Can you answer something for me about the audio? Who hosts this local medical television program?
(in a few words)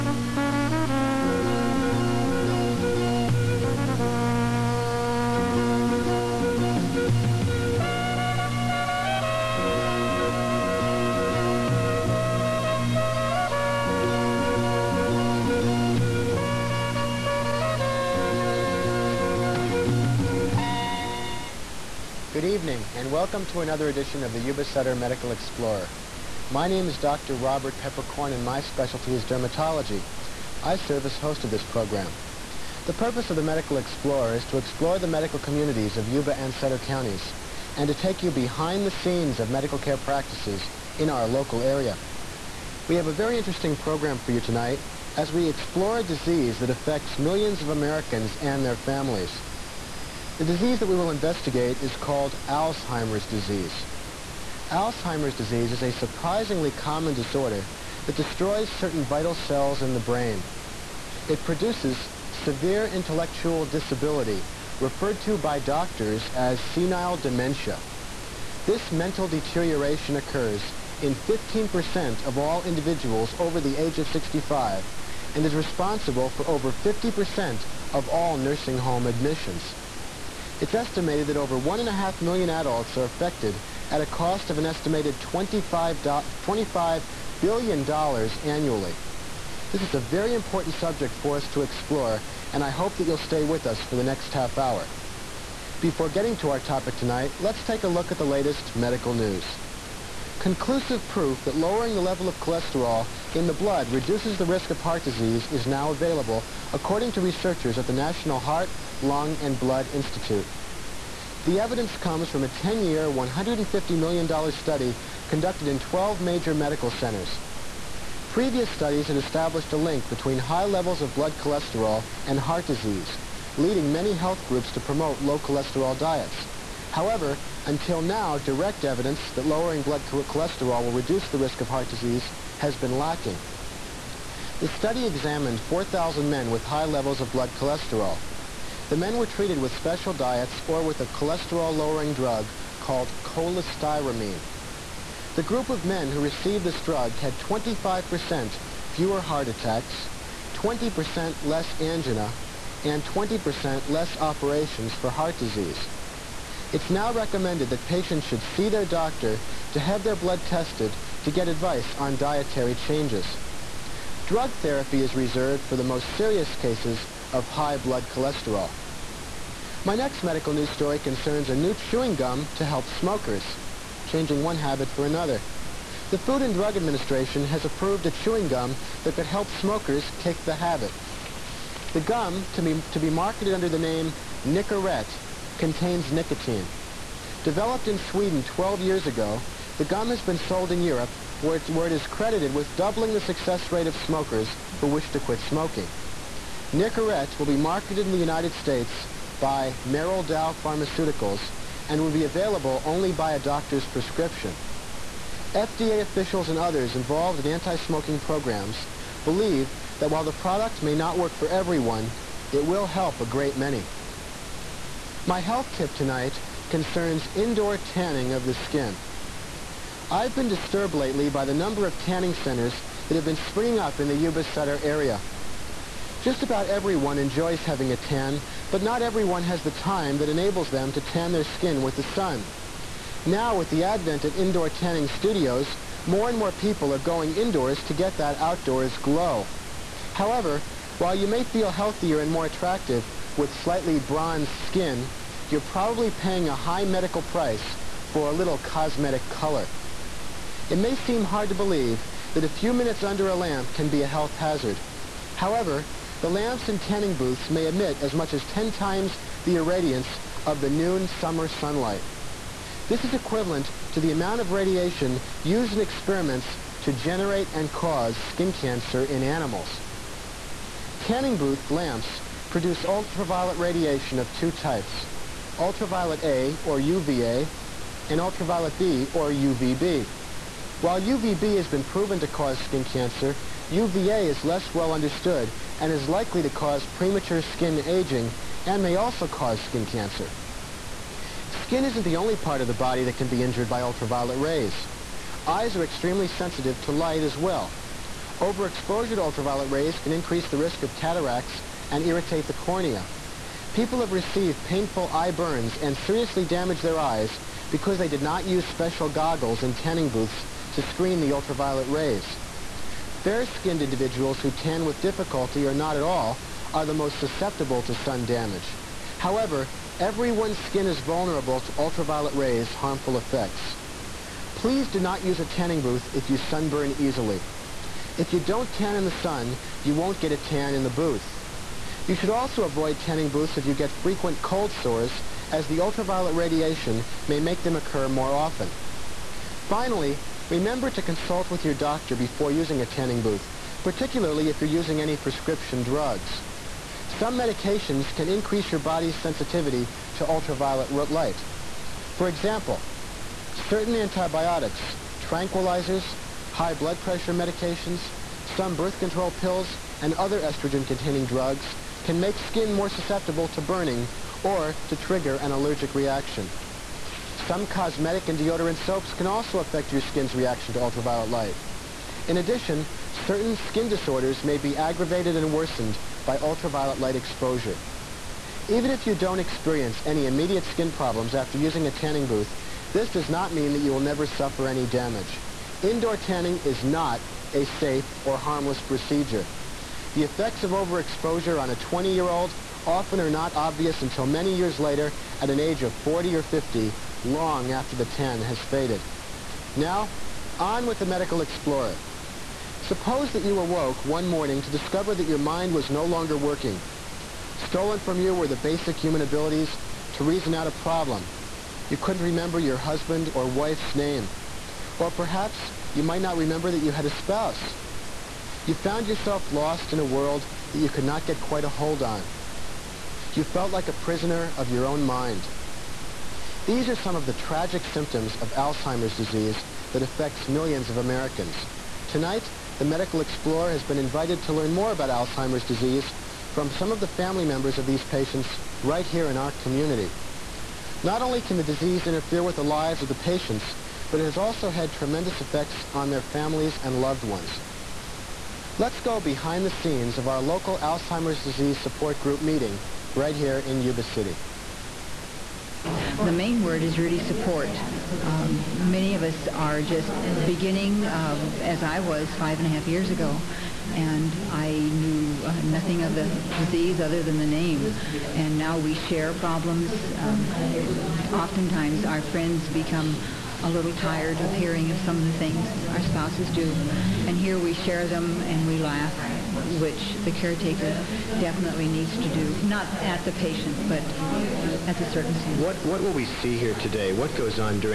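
Robert Peppercorn.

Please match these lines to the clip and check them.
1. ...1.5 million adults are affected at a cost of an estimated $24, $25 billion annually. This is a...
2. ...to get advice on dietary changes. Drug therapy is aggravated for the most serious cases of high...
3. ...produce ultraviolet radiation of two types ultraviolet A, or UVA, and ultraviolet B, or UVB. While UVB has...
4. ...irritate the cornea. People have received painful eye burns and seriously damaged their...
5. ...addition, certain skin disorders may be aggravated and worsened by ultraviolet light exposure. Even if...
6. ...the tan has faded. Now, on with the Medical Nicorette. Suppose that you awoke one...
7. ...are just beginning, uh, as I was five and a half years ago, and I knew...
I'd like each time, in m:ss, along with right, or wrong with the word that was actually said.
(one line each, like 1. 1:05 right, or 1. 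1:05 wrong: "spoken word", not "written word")
1. 1:21 wrong: "25", not "24"
2. 2:41 wrong: "reserved", not "aggravated"
3. 4:32 right
4. 5:02 right
5. 6:12 right
6. 6:37 wrong: "Explorer", not "Nicorette"
7. 7:39 right.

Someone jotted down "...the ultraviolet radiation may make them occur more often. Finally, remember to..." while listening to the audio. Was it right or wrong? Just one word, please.
right.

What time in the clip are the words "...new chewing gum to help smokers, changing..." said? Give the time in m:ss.
2:51.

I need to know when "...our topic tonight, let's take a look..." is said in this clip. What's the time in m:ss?
1:36.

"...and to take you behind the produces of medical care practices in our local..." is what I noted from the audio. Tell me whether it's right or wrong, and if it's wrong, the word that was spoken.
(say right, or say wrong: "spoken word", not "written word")
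wrong: "scenes", not "produces".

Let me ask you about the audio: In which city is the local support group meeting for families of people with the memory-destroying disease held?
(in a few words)
Yuba City.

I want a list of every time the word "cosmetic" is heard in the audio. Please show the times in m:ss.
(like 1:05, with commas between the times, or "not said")
4:08, 6:07.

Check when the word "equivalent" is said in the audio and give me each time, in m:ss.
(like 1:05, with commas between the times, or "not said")
4:23.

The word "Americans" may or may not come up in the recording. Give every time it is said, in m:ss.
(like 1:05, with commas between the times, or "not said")
0:47, 7:10.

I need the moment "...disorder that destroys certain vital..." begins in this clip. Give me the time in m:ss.
0:57.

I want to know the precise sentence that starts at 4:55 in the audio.
Eyes are extremely sensitive to light as well.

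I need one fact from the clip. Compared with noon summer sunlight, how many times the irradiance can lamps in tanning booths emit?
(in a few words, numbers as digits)
10 times.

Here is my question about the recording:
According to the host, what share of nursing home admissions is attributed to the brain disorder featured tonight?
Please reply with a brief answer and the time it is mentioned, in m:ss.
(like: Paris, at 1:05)
over 50%, at 1:16.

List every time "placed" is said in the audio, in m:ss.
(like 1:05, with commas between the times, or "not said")
not said.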